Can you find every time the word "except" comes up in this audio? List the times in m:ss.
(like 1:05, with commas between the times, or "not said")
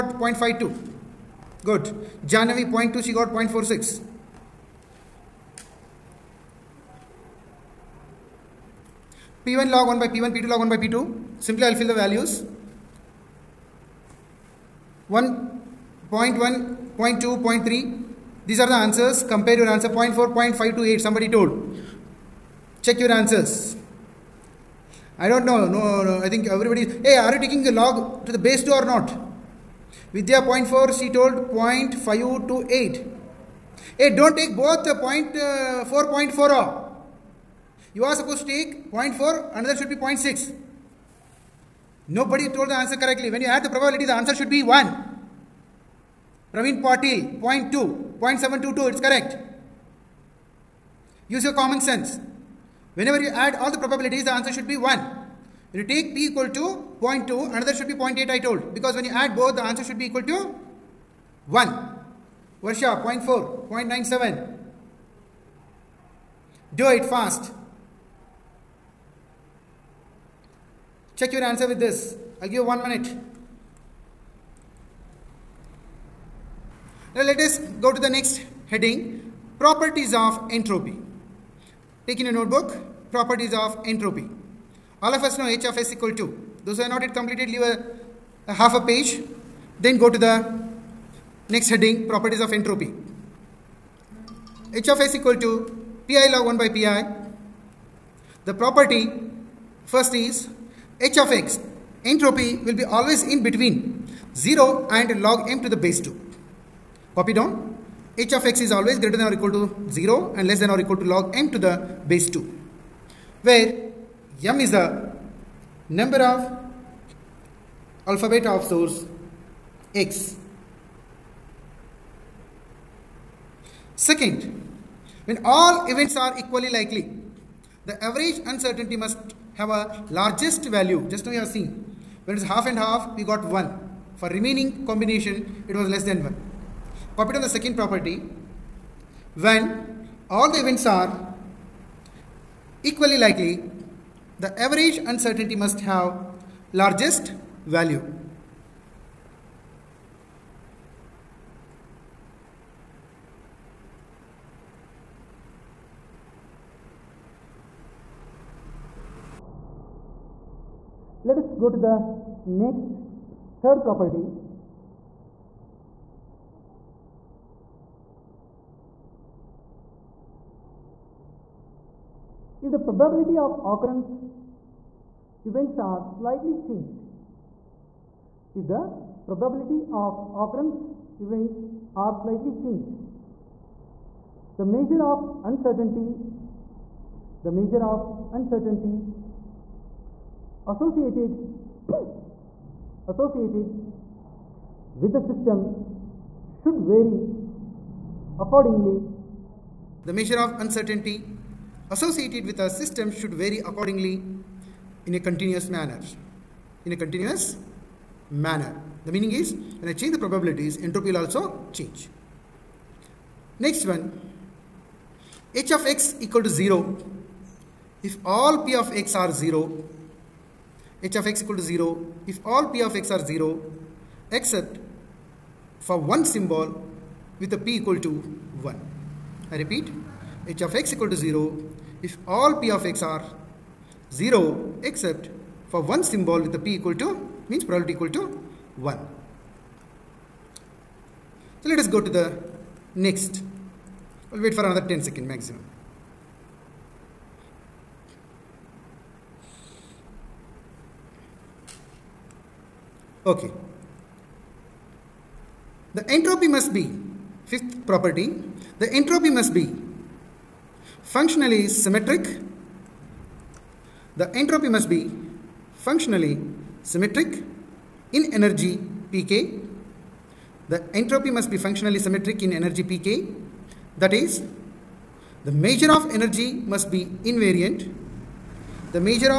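3:44, 3:54.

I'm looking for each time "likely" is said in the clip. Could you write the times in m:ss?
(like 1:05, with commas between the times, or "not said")
2:06, 2:23.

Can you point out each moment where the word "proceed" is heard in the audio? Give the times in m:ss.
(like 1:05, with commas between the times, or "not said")
not said.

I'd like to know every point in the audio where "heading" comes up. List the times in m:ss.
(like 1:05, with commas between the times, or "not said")
1:18, 1:31.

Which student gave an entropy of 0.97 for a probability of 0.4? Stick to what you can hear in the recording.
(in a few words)
Varsha.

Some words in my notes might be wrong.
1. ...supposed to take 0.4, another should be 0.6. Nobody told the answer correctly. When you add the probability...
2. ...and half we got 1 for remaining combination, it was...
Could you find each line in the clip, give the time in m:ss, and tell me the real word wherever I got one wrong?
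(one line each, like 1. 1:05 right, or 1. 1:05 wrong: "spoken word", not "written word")
1. 0:38 right
2. 2:12 right.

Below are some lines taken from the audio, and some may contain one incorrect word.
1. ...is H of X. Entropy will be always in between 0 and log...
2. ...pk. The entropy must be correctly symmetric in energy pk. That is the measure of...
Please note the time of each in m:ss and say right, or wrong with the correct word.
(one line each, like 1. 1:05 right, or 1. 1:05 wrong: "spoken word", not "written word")
1. 1:40 right
2. 4:29 wrong: "functionally", not "correctly".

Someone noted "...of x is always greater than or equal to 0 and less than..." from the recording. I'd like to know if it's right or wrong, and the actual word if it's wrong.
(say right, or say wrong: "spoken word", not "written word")
right.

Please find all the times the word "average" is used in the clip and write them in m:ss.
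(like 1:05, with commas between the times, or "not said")
2:08, 2:24.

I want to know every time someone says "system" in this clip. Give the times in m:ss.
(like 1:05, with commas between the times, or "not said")
3:15, 3:22.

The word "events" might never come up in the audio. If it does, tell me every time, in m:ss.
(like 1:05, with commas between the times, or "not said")
2:05, 2:20, 2:55, 3:01.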